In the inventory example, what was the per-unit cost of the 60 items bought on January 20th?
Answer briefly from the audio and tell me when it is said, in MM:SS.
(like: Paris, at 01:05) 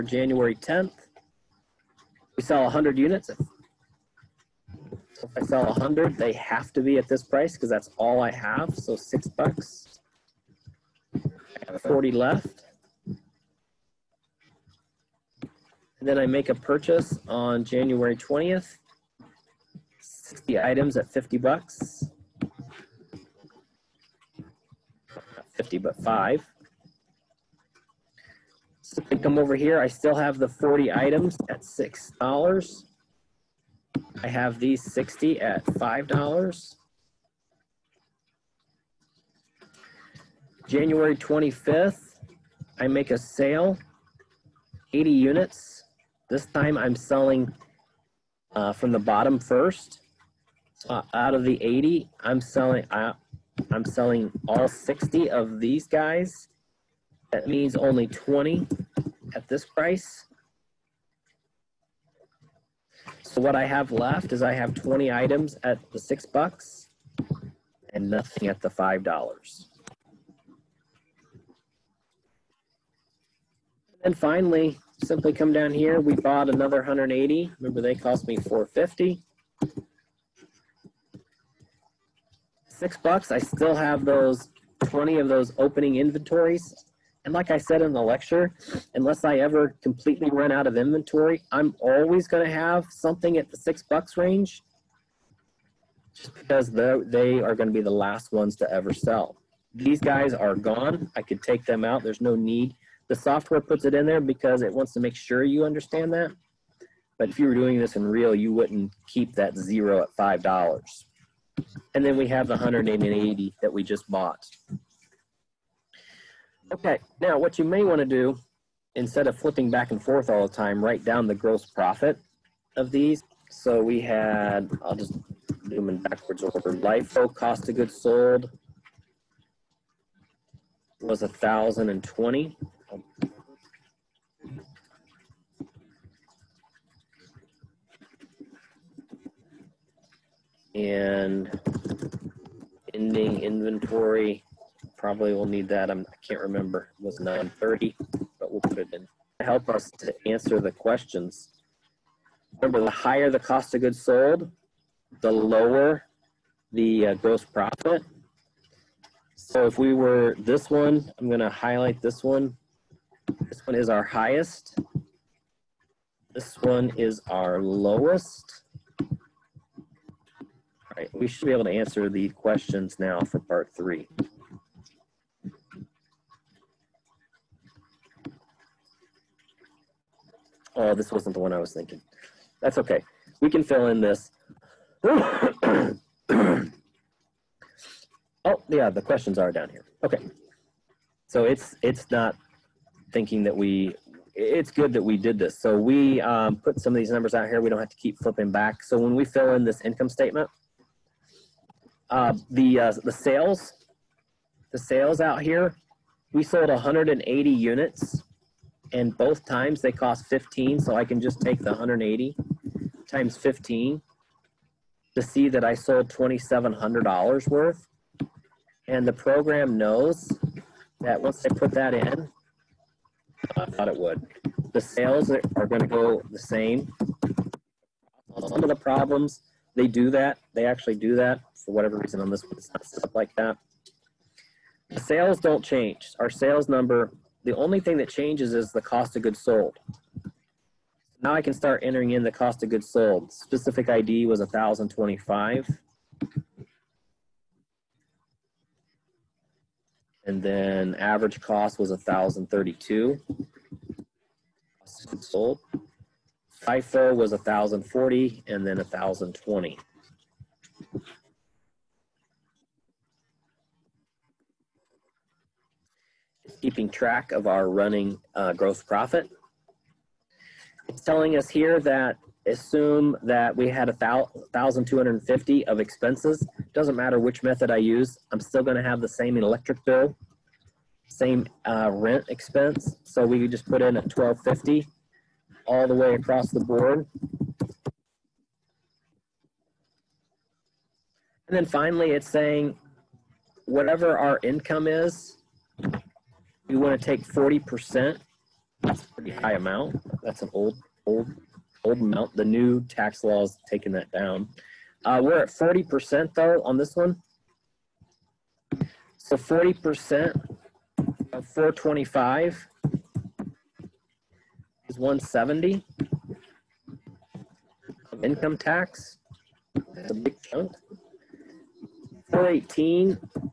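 $5, at 00:25.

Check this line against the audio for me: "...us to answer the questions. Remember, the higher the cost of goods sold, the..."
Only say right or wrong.
right.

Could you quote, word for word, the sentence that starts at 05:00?
That's an old, old, old amount.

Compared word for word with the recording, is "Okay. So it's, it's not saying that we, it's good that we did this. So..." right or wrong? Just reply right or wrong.
wrong.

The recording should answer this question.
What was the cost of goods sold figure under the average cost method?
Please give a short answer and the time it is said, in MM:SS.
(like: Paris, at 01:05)
1,032, at 04:11.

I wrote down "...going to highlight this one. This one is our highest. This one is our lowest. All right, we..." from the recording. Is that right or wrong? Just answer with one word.
right.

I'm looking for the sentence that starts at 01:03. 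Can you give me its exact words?
So what I have left is I have 20 items at the six bucks and nothing at the five dollars.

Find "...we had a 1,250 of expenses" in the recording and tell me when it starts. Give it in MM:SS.
04:33.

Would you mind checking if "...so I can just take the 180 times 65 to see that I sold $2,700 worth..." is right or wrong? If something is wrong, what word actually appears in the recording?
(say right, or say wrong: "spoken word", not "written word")
wrong: "15", not "65".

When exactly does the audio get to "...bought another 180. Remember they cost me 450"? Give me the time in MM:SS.
01:16.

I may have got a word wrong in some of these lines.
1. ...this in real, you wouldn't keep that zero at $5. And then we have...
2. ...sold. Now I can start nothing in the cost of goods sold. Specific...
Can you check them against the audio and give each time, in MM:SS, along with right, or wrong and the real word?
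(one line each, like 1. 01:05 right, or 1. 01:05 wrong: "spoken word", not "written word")
1. 01:47 right
2. 03:59 wrong: "entering", not "nothing".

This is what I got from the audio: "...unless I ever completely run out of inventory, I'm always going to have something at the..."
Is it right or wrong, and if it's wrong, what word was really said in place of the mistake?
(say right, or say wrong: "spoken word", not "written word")
right.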